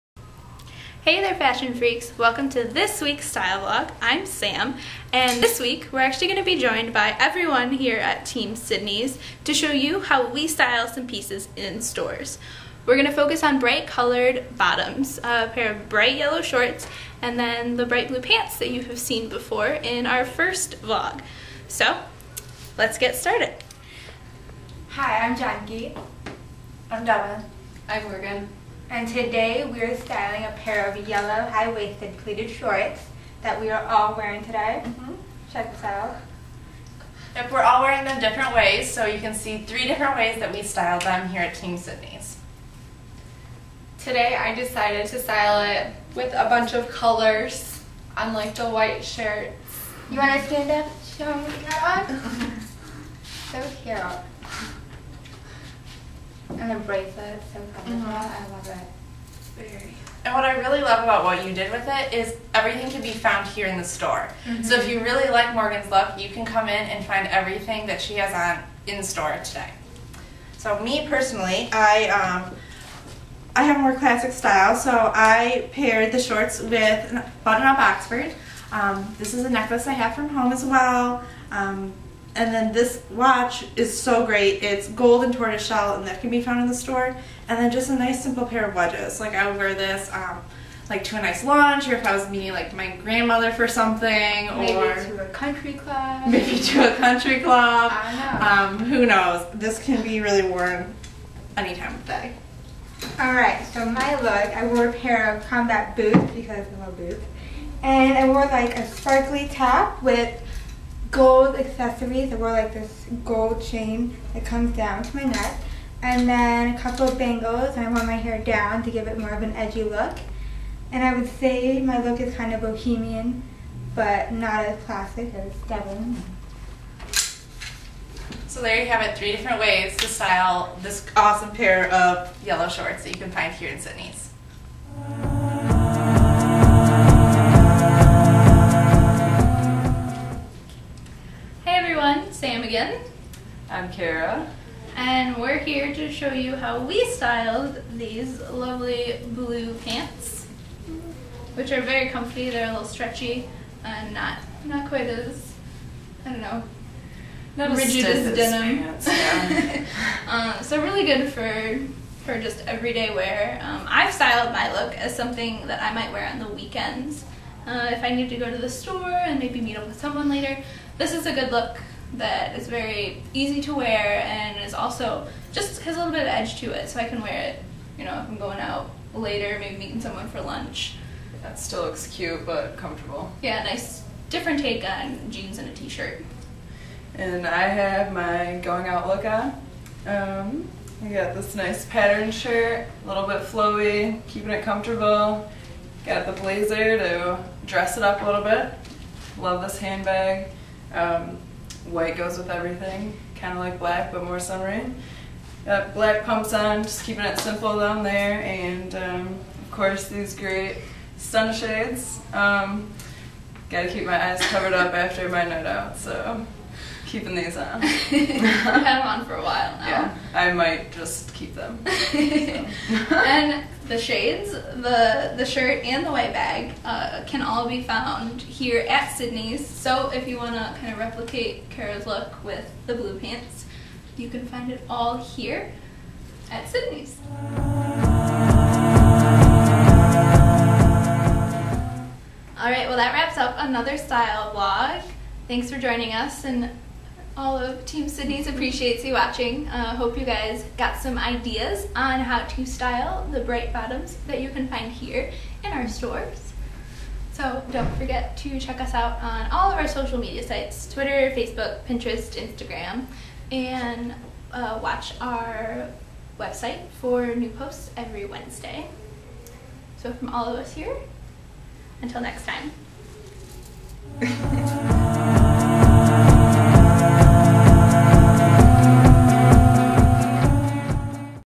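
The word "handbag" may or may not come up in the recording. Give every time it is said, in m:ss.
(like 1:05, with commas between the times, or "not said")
3:19.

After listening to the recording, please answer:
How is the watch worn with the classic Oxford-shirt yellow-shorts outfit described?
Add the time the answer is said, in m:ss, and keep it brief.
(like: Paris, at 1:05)
gold and tortoiseshell, at 1:24.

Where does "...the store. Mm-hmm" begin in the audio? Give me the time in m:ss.
1:03.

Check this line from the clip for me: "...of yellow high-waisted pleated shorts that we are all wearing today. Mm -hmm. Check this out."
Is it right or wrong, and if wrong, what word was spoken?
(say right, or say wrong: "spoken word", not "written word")
right.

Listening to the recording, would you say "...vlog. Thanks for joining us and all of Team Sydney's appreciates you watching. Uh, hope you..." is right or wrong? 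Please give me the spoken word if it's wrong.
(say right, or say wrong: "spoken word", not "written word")
right.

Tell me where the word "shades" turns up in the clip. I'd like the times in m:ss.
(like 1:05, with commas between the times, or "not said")
3:31, 3:43.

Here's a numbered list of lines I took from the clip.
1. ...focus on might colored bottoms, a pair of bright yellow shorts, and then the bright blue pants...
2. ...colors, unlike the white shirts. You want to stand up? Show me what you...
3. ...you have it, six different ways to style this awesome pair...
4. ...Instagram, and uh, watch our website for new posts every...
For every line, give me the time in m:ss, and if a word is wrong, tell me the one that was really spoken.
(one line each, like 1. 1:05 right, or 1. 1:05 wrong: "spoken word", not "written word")
1. 0:13 wrong: "bright", not "might"
2. 0:47 right
3. 2:08 wrong: "three", not "six"
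4. 4:22 right.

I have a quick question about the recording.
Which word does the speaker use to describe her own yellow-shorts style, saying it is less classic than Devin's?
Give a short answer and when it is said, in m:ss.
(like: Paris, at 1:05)
bohemian, at 2:02.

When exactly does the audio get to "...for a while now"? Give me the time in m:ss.
3:39.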